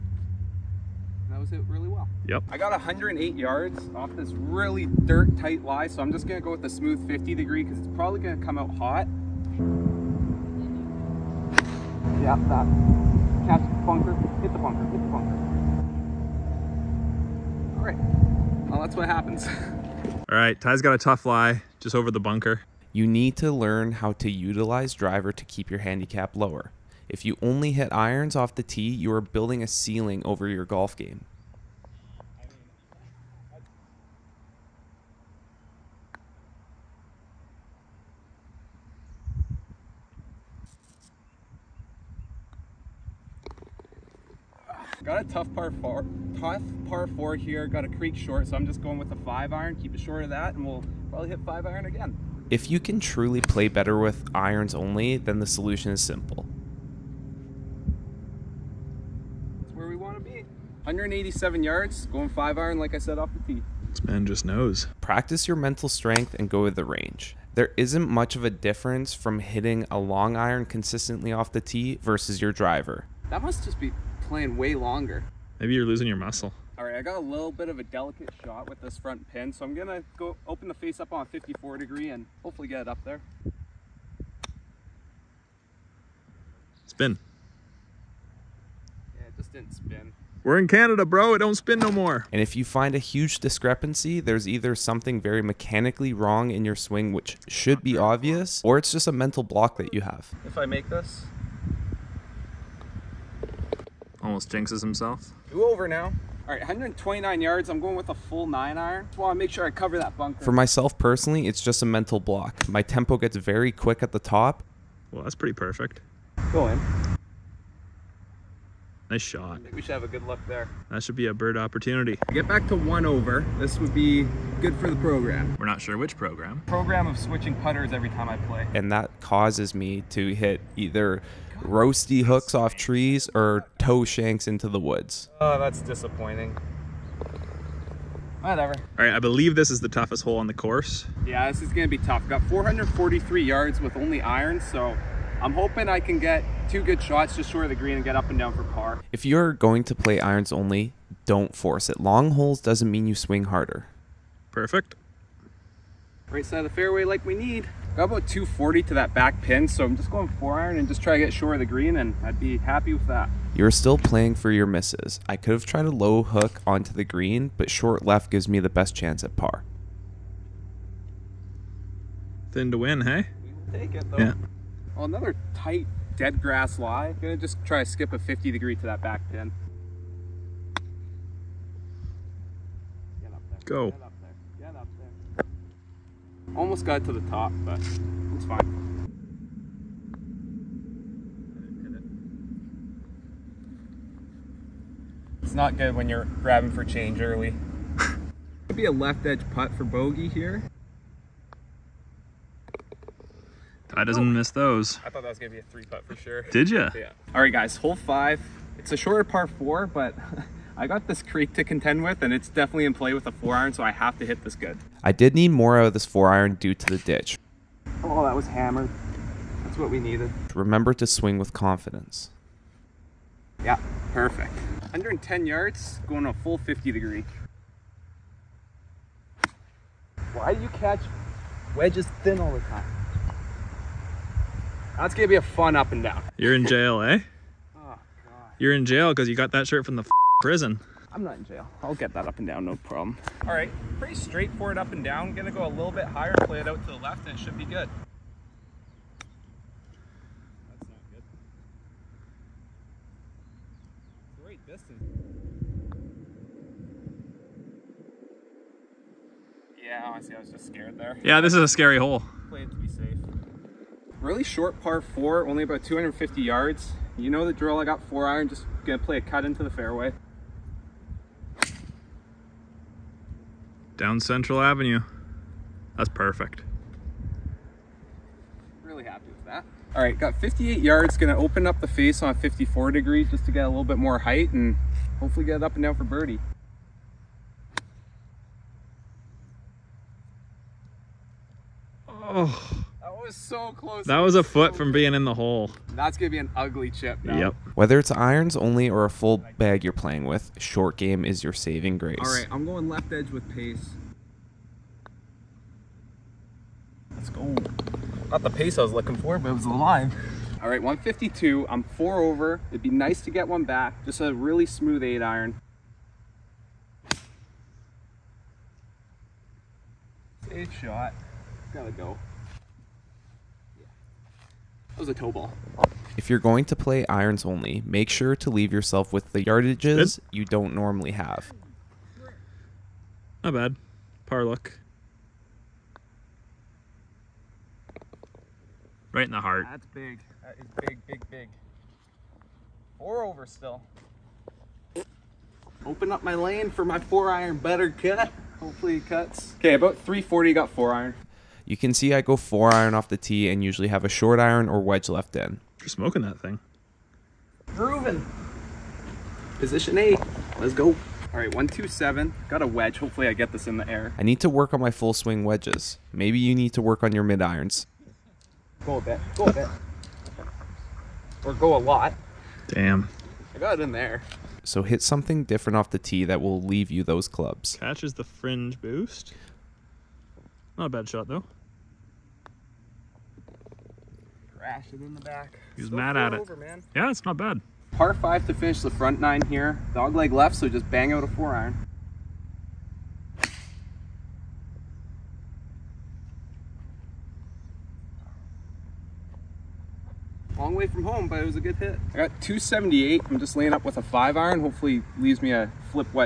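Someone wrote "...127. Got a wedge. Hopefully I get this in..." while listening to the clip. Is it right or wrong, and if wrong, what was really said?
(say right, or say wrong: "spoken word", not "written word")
right.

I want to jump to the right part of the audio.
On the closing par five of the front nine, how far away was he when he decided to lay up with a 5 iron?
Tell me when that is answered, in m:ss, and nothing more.
6:42.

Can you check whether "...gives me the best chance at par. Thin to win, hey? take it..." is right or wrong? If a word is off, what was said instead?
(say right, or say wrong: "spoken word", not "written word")
right.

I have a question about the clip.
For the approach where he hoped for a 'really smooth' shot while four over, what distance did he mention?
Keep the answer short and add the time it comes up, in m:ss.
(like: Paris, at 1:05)
152, at 5:10.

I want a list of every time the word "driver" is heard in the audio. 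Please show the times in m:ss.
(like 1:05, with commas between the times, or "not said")
0:24, 1:12.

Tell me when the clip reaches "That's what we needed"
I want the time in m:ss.
3:39.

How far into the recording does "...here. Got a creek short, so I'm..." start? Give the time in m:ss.
0:47.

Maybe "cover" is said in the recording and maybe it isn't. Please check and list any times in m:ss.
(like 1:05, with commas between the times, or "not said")
1:49.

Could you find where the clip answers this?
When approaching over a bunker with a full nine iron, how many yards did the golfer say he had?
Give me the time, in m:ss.
1:46.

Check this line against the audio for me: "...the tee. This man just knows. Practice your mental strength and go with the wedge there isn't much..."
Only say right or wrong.
wrong.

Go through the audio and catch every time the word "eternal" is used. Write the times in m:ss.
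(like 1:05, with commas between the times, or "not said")
not said.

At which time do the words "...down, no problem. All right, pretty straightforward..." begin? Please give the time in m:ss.
4:02.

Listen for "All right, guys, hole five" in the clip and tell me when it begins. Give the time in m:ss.
3:27.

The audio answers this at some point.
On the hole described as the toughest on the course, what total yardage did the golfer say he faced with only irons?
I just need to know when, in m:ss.
2:22.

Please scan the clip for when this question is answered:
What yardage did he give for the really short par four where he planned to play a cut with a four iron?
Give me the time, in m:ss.
4:25.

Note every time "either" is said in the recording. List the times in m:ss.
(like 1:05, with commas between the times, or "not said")
1:34, 2:10.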